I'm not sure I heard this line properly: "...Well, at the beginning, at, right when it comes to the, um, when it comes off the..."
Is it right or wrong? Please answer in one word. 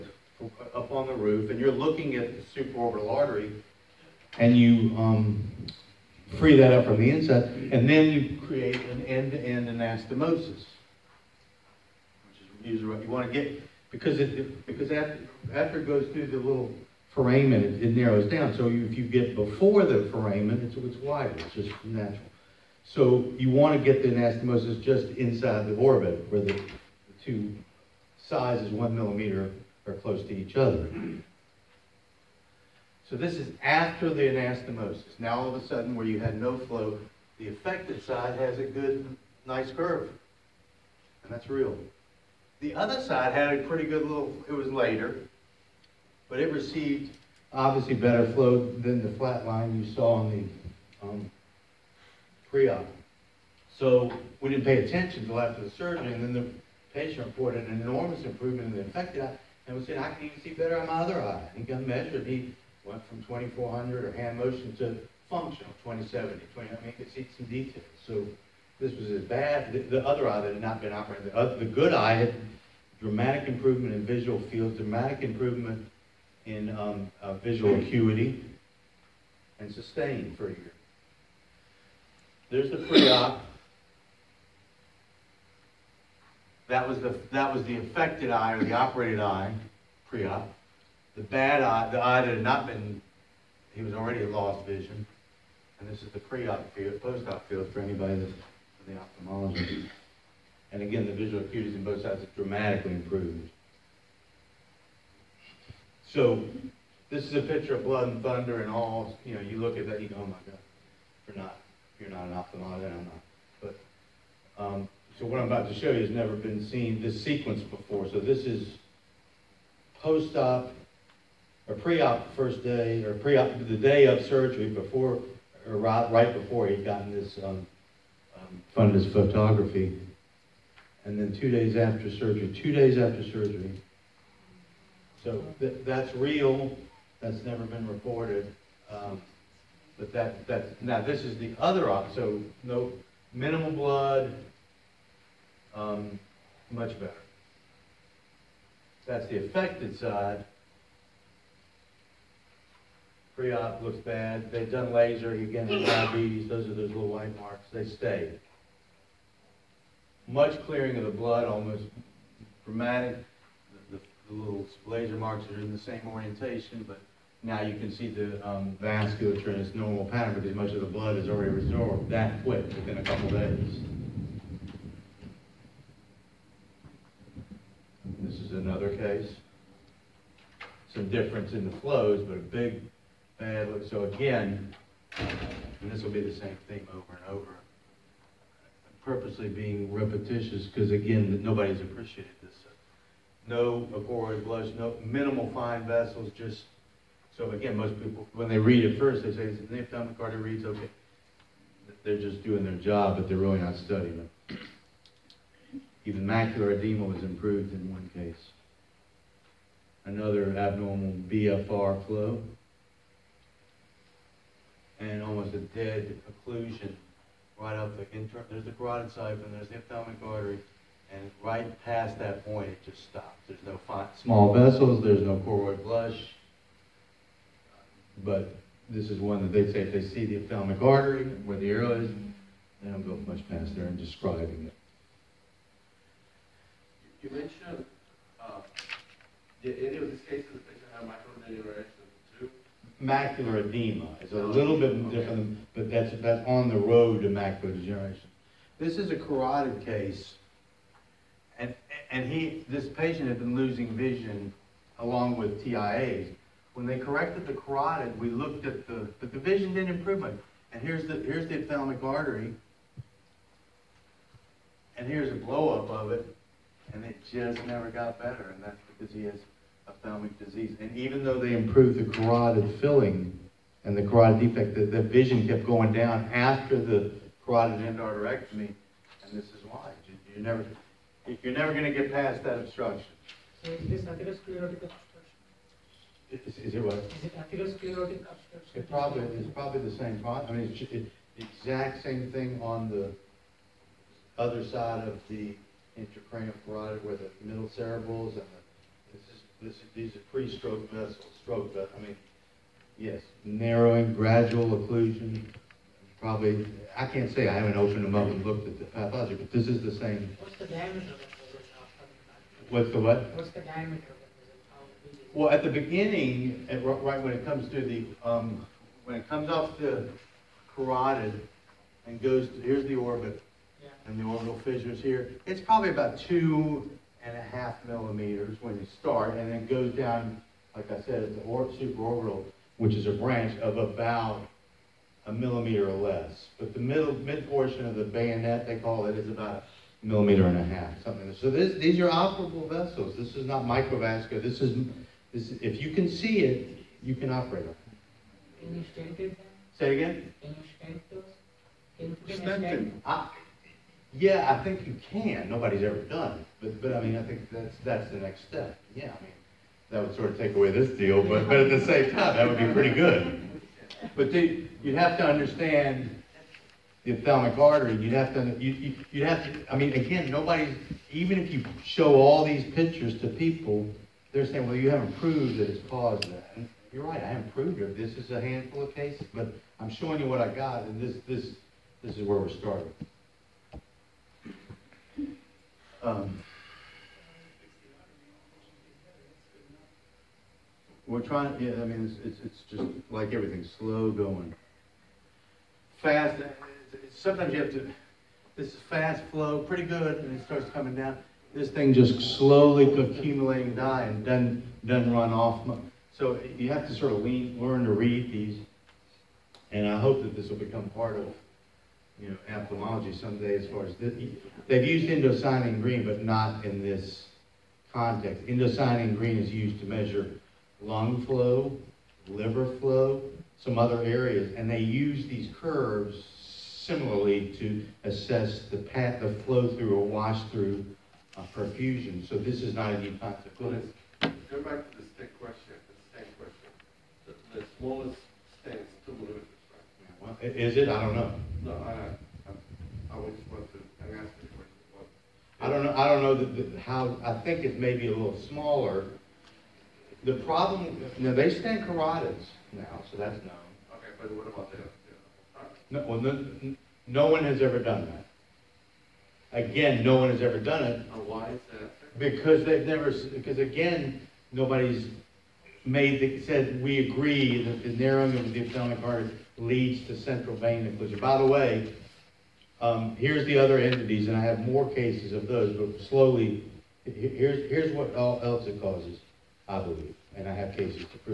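right.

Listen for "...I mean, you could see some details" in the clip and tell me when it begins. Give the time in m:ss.
1:06.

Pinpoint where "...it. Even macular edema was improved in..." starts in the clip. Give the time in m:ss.
3:24.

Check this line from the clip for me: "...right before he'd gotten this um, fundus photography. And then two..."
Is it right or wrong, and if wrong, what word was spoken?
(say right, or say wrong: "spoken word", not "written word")
right.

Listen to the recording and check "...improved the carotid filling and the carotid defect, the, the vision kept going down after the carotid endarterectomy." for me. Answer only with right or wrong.
right.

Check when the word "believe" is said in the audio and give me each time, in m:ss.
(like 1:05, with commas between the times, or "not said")
7:59.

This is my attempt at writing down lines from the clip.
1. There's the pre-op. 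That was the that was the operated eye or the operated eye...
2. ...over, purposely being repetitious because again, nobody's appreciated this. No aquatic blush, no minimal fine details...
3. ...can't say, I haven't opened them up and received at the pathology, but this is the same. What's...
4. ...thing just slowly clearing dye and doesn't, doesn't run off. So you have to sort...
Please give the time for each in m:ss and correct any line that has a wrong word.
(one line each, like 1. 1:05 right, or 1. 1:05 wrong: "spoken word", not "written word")
1. 1:22 wrong: "affected", not "operated"
2. 3:07 wrong: "vessels", not "details"
3. 5:07 wrong: "looked", not "received"
4. 6:41 wrong: "accumulating", not "clearing".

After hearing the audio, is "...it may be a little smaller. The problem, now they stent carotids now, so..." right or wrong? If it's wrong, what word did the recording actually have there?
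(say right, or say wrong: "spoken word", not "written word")
right.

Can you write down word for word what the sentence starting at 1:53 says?
But, um, so what I'm about to show you has never been seen this sequence before.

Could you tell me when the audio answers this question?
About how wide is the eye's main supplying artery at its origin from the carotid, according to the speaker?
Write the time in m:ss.
5:26.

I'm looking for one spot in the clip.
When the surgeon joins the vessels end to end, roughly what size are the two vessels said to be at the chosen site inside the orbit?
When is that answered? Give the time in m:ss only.
0:28.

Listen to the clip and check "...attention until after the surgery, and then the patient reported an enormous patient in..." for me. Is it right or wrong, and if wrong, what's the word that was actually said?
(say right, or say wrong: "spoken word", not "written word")
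wrong: "improvement", not "patient".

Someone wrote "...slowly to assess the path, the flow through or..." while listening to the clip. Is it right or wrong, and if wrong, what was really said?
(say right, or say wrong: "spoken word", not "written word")
wrong: "similarly", not "slowly".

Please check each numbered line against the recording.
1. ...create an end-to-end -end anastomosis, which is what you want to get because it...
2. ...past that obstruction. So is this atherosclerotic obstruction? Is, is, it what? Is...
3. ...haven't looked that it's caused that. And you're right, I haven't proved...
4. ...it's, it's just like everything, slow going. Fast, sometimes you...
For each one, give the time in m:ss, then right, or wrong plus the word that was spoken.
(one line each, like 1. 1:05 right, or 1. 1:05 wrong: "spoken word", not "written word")
1. 0:08 right
2. 4:42 right
3. 6:14 wrong: "proved", not "looked"
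4. 6:32 right.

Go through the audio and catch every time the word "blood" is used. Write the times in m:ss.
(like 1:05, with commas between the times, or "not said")
1:47, 2:23, 2:41, 2:50.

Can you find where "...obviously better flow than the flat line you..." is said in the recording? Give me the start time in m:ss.
0:47.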